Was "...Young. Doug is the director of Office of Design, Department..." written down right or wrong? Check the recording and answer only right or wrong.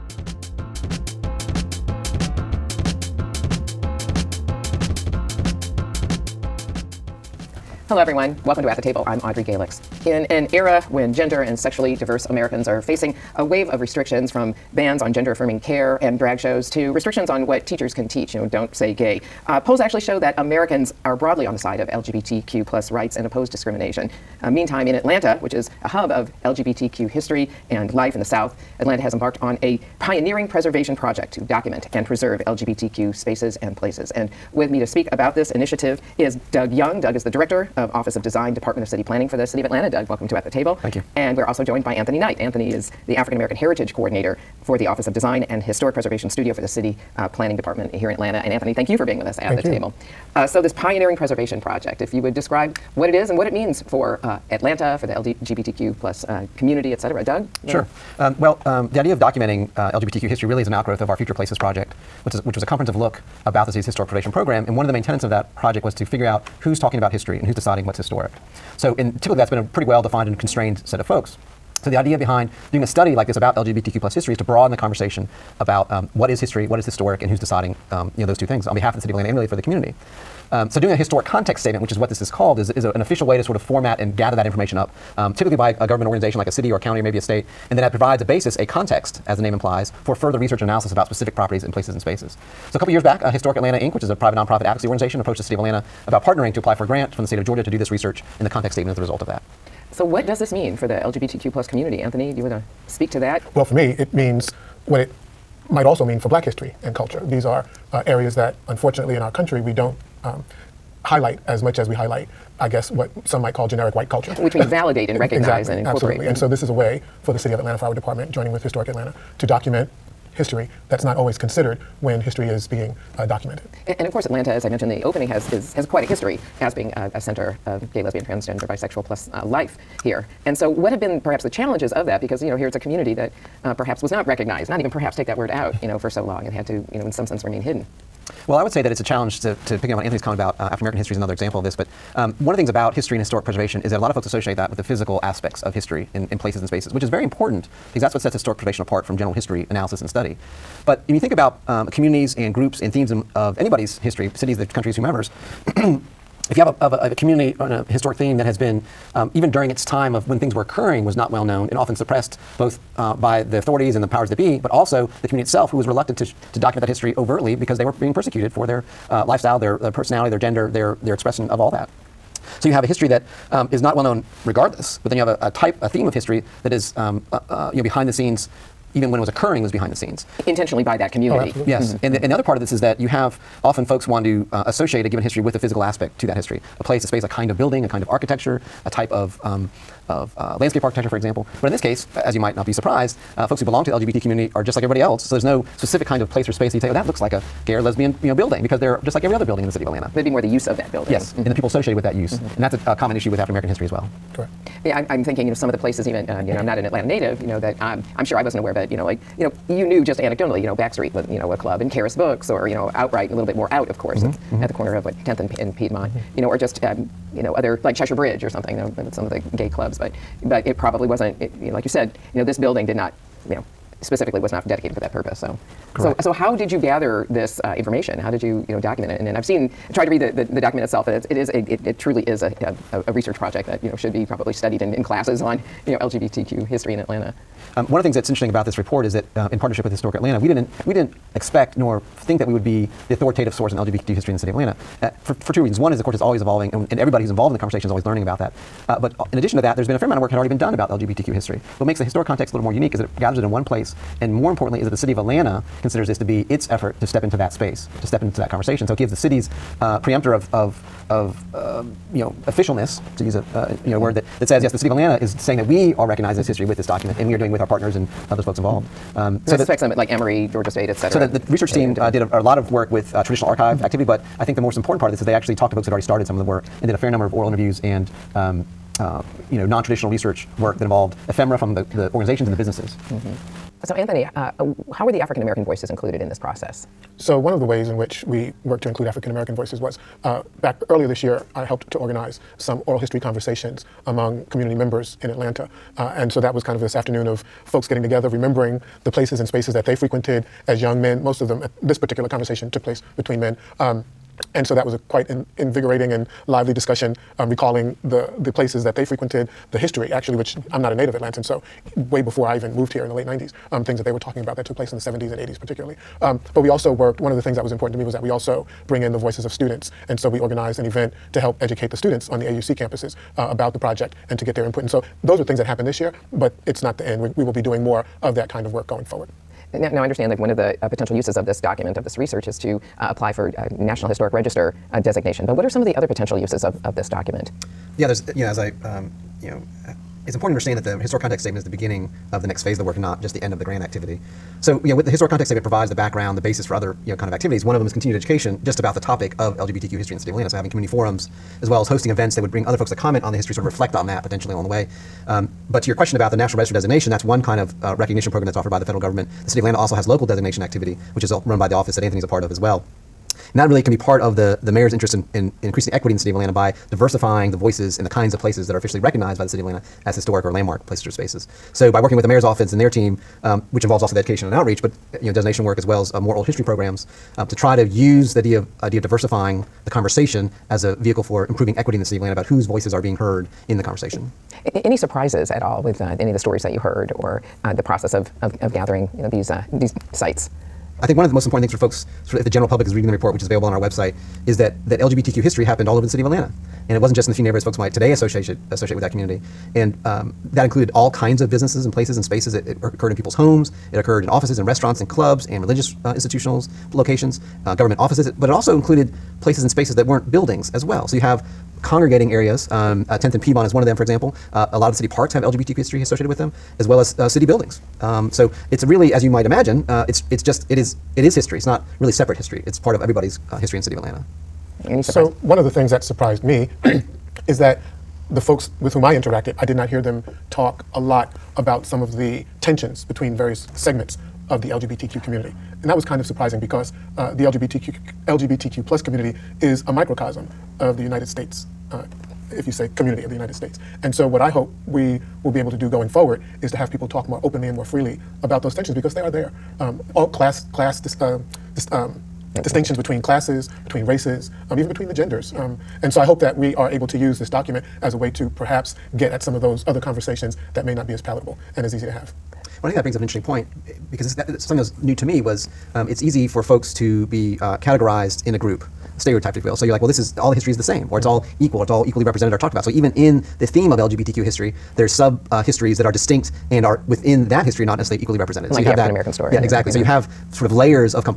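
right.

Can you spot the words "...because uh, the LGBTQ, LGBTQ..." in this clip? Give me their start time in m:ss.
7:16.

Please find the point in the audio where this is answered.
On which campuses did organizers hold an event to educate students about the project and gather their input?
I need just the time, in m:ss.
5:22.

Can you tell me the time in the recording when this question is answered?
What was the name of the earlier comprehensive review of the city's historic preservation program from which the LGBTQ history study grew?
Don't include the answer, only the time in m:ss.
1:01.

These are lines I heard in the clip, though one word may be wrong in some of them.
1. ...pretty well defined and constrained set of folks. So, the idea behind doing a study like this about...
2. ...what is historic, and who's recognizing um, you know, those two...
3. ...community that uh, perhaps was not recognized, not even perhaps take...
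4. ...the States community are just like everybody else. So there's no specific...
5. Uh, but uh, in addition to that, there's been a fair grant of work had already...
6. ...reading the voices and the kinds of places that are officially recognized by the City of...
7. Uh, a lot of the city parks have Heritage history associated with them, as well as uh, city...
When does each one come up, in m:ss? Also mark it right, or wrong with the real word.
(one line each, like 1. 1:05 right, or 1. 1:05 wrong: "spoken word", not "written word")
1. 1:09 right
2. 1:16 wrong: "deciding", not "recognizing"
3. 2:12 right
4. 3:13 wrong: "LGBT", not "States"
5. 4:08 wrong: "amount", not "grant"
6. 6:06 wrong: "diversifying", not "reading"
7. 6:54 wrong: "LGBTQ", not "Heritage".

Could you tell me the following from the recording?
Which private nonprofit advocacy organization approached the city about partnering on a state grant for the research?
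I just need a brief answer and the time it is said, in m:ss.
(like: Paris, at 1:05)
Historic Atlanta Inc., at 1:33.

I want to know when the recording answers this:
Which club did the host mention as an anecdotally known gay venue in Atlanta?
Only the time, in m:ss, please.
3:30.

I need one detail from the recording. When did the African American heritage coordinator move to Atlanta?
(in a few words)
late 90s.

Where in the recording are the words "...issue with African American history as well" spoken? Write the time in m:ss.
3:23.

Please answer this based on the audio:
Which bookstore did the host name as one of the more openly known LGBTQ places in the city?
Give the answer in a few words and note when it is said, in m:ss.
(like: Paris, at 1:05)
Charis Books, at 3:31.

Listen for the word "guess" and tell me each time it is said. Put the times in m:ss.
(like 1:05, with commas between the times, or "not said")
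1:52.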